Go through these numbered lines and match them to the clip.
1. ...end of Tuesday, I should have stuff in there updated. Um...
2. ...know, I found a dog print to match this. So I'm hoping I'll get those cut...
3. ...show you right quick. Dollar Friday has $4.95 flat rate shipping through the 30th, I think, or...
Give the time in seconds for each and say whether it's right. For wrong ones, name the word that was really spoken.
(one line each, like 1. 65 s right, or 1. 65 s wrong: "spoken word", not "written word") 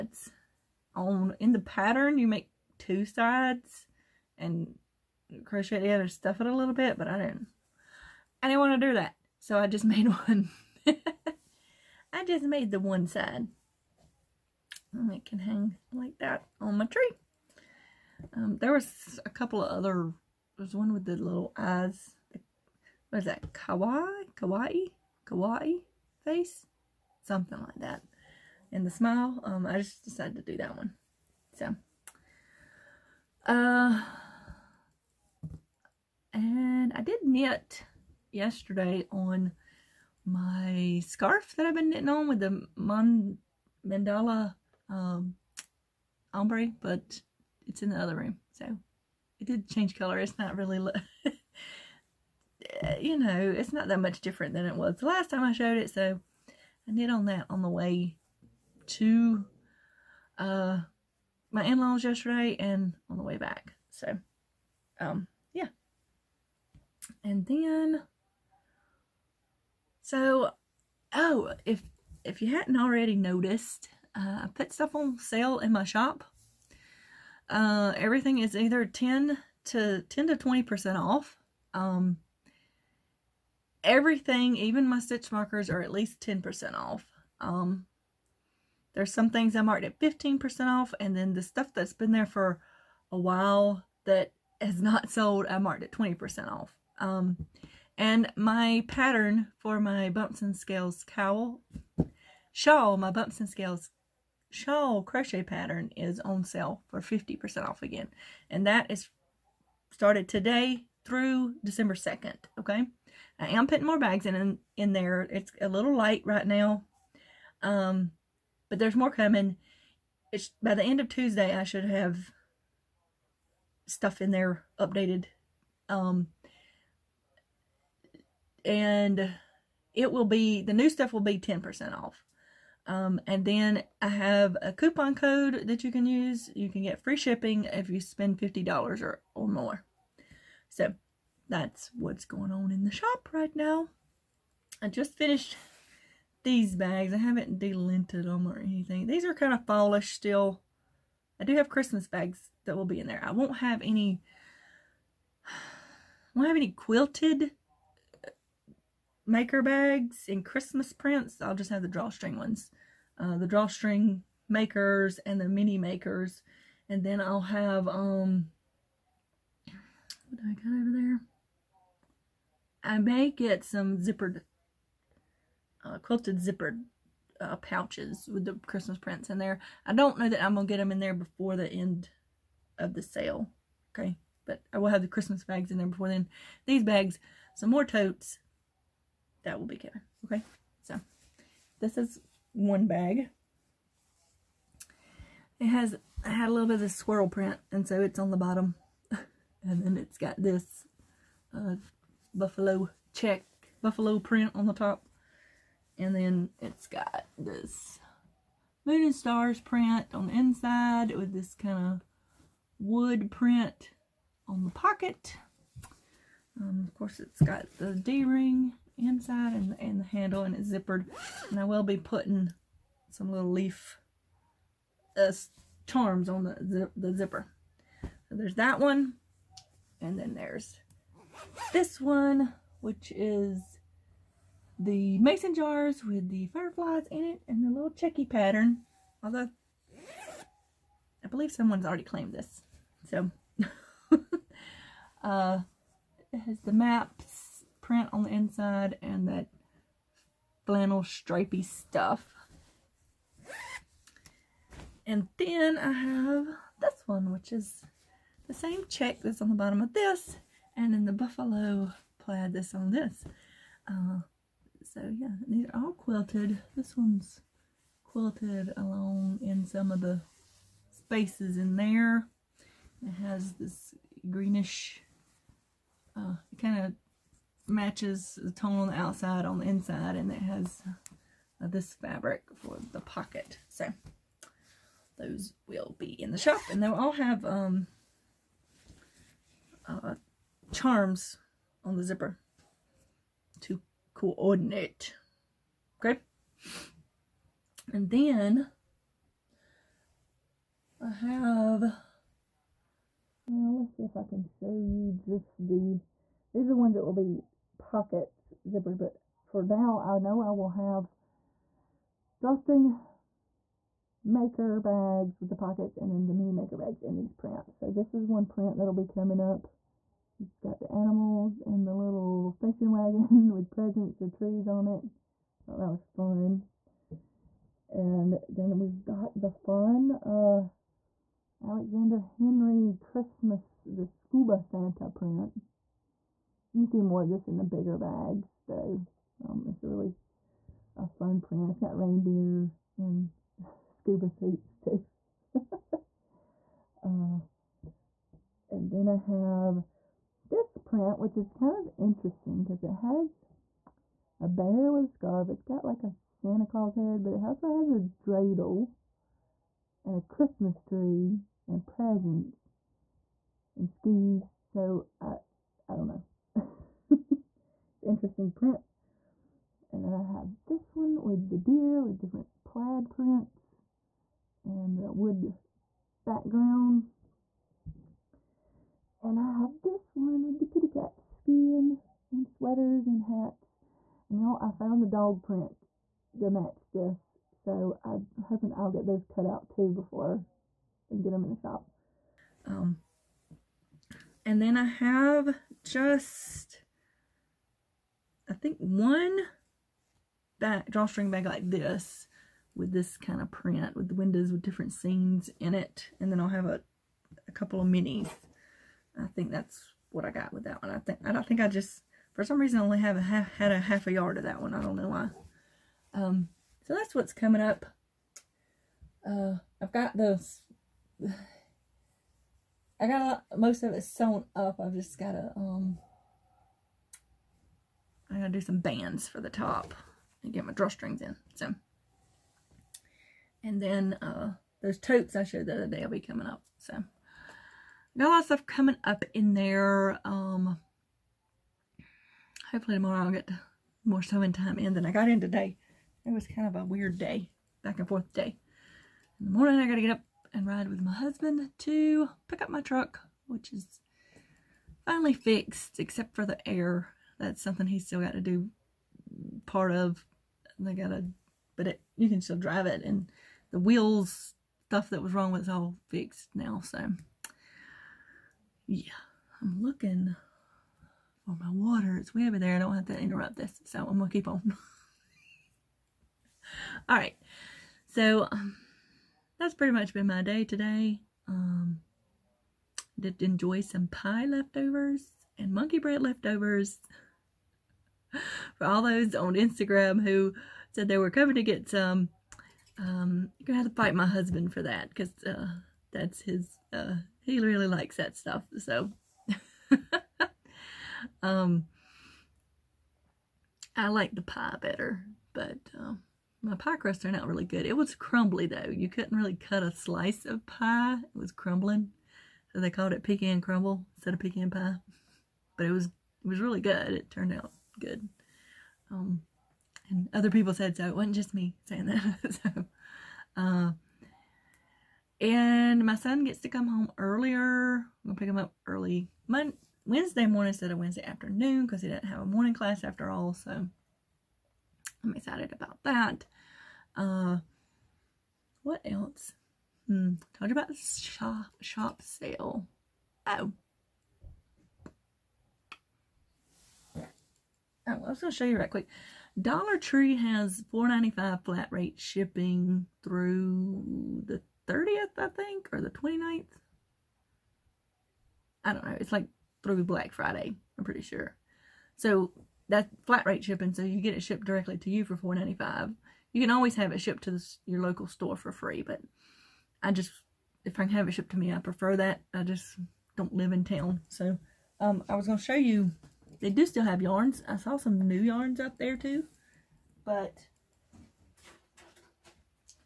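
1. 120 s right
2. 384 s right
3. 548 s wrong: "Tree", not "Friday".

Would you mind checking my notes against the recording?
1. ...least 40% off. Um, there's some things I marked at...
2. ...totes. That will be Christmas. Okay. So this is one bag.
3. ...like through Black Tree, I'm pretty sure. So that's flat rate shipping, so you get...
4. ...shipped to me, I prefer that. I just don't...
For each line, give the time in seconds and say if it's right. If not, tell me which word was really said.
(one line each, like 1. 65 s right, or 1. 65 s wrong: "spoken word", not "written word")
1. 85 s wrong: "10", not "40"
2. 187 s wrong: "Kevin", not "Christmas"
3. 559 s wrong: "Friday", not "Tree"
4. 571 s right.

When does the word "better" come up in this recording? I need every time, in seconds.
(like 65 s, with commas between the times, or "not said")
504 s.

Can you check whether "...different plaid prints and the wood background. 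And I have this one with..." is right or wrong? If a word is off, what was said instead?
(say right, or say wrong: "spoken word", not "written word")
right.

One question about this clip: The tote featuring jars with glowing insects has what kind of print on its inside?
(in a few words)
maps.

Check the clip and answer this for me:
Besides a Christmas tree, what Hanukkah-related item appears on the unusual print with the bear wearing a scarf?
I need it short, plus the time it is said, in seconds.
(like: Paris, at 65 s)
dreidel, at 358 s.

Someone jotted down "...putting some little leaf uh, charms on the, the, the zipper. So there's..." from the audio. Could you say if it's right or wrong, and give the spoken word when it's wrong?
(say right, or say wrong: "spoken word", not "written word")
right.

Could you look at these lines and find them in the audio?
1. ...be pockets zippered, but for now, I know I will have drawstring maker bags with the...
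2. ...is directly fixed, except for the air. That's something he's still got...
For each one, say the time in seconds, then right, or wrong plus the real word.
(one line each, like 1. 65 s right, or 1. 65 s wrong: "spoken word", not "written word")
1. 307 s right
2. 453 s wrong: "finally", not "directly".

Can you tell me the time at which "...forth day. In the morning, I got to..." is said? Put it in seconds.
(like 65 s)
448 s.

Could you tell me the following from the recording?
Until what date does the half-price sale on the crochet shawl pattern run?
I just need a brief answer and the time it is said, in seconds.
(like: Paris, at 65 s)
December 2nd, at 111 s.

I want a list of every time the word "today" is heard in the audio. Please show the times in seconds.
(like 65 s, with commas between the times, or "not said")
110 s, 445 s, 480 s.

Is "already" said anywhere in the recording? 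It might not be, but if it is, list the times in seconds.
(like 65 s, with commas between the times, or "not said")
72 s, 241 s.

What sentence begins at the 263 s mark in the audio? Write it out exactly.
Uh, so yeah, these are all quilted.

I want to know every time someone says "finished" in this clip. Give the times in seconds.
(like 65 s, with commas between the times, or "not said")
145 s.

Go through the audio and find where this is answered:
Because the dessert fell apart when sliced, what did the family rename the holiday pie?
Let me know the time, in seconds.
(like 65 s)
513 s.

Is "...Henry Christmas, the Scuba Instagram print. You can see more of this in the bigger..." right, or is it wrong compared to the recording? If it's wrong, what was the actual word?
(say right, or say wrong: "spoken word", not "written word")
wrong: "Santa", not "Instagram".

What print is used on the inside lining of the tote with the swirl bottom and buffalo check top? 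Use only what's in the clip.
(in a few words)
moon and stars.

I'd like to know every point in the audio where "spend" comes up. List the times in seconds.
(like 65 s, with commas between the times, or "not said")
137 s.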